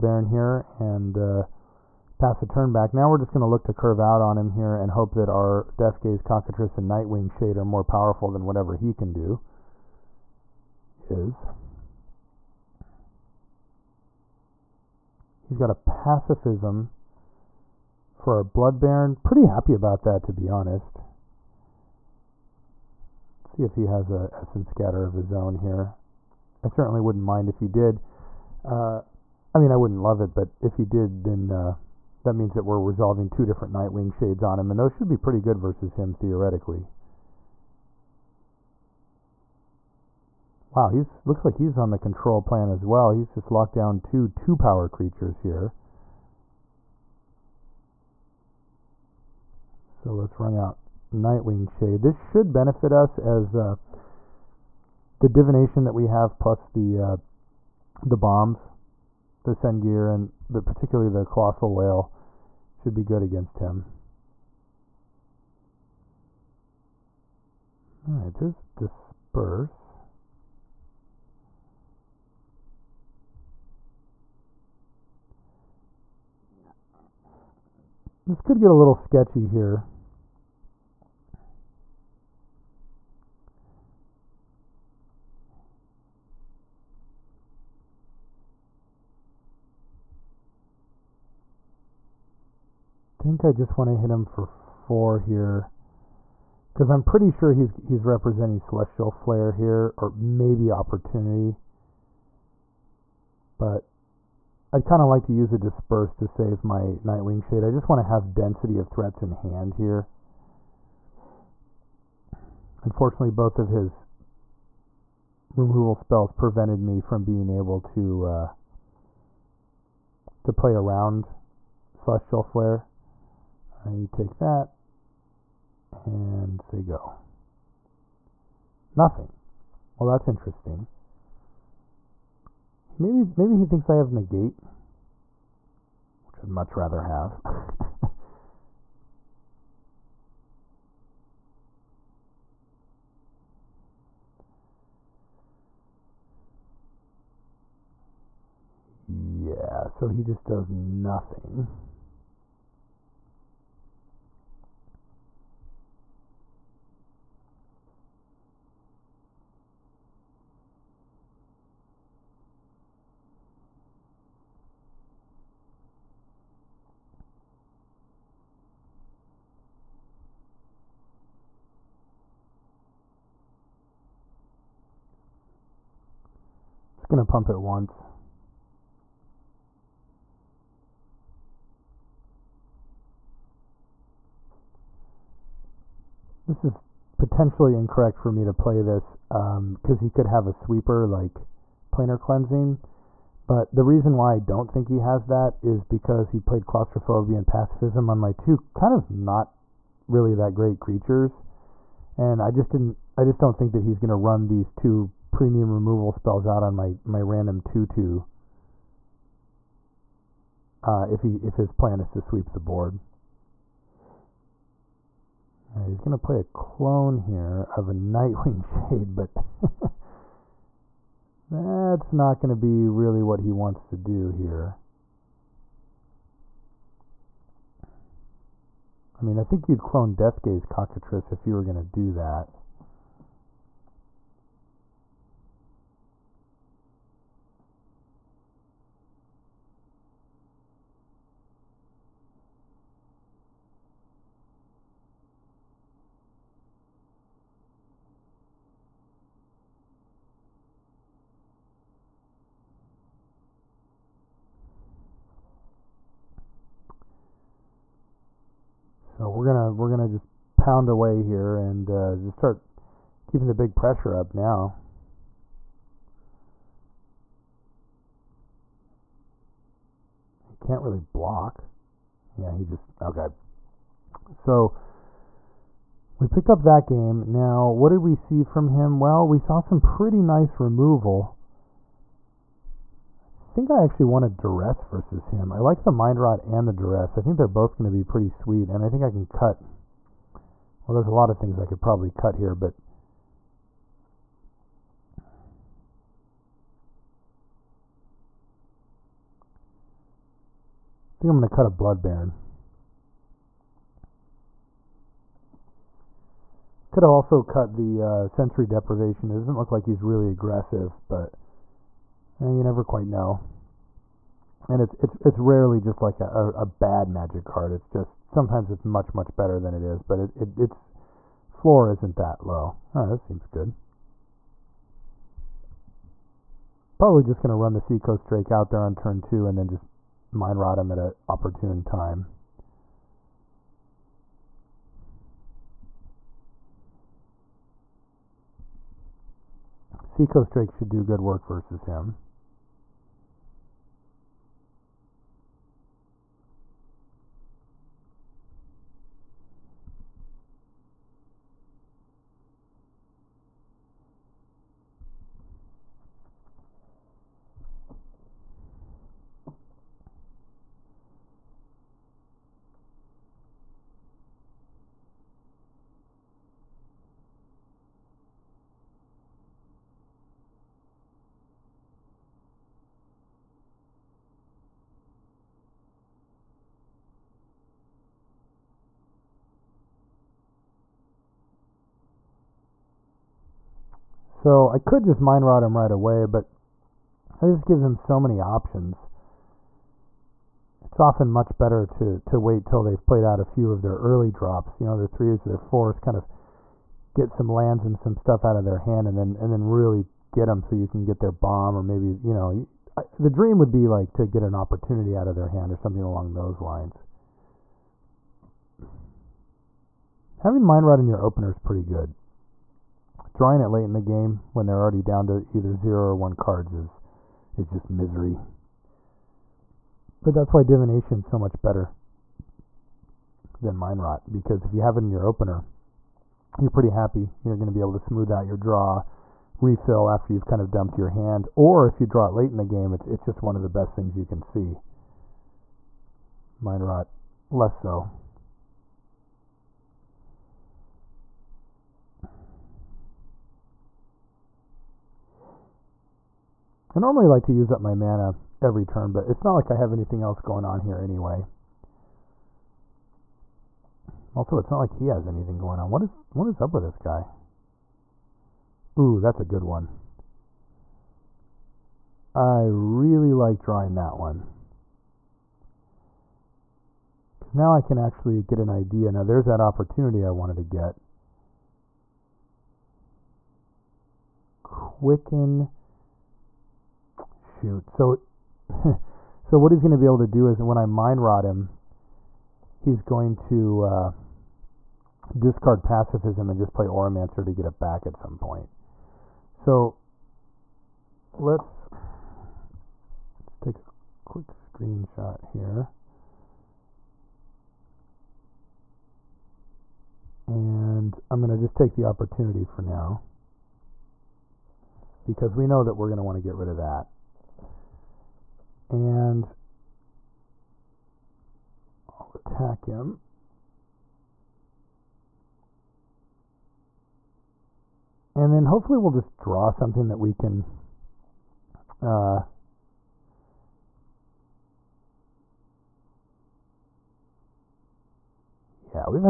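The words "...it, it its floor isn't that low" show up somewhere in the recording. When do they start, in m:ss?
5:20.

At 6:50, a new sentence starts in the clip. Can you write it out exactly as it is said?
Having mind rot in your opener is pretty good.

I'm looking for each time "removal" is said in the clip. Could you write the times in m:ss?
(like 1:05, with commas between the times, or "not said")
1:55, 3:25, 4:40.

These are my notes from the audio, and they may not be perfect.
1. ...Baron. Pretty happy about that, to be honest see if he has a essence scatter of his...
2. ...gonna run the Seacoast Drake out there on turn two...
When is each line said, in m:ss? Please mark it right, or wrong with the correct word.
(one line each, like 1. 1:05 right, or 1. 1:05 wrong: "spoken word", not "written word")
1. 0:18 right
2. 5:27 right.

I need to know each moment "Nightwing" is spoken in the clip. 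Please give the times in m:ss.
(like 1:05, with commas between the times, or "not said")
0:06, 0:33, 0:51, 1:47, 3:37.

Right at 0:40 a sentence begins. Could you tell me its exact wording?
Wow, he's looks like he's on the control plan as well.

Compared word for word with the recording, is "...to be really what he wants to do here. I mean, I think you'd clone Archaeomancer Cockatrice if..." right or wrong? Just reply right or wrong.
wrong.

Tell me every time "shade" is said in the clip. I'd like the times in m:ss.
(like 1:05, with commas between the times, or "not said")
0:07, 0:34, 0:51, 1:47, 3:38.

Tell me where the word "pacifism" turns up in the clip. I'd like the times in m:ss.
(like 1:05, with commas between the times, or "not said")
0:15, 3:17, 8:05.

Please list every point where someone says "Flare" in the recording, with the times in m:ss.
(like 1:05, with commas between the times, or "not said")
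1:39, 2:02.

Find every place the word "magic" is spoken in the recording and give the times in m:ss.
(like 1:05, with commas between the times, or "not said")
5:17.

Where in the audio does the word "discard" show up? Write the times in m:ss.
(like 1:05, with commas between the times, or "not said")
8:05.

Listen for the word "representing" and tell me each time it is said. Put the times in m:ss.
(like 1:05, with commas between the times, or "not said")
1:38.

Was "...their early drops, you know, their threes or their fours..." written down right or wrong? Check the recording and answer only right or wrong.
right.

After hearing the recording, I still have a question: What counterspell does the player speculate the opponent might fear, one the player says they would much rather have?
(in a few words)
Negate.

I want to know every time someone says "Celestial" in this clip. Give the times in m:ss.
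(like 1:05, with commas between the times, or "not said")
1:38, 2:01.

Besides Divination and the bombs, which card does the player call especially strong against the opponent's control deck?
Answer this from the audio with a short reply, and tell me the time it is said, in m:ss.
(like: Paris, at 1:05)
Colossal Whale, at 1:01.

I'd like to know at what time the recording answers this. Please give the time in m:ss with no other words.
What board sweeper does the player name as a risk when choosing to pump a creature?
3:11.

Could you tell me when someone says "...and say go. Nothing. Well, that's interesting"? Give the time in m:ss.
2:06.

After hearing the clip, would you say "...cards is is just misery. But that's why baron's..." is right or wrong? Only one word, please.
wrong.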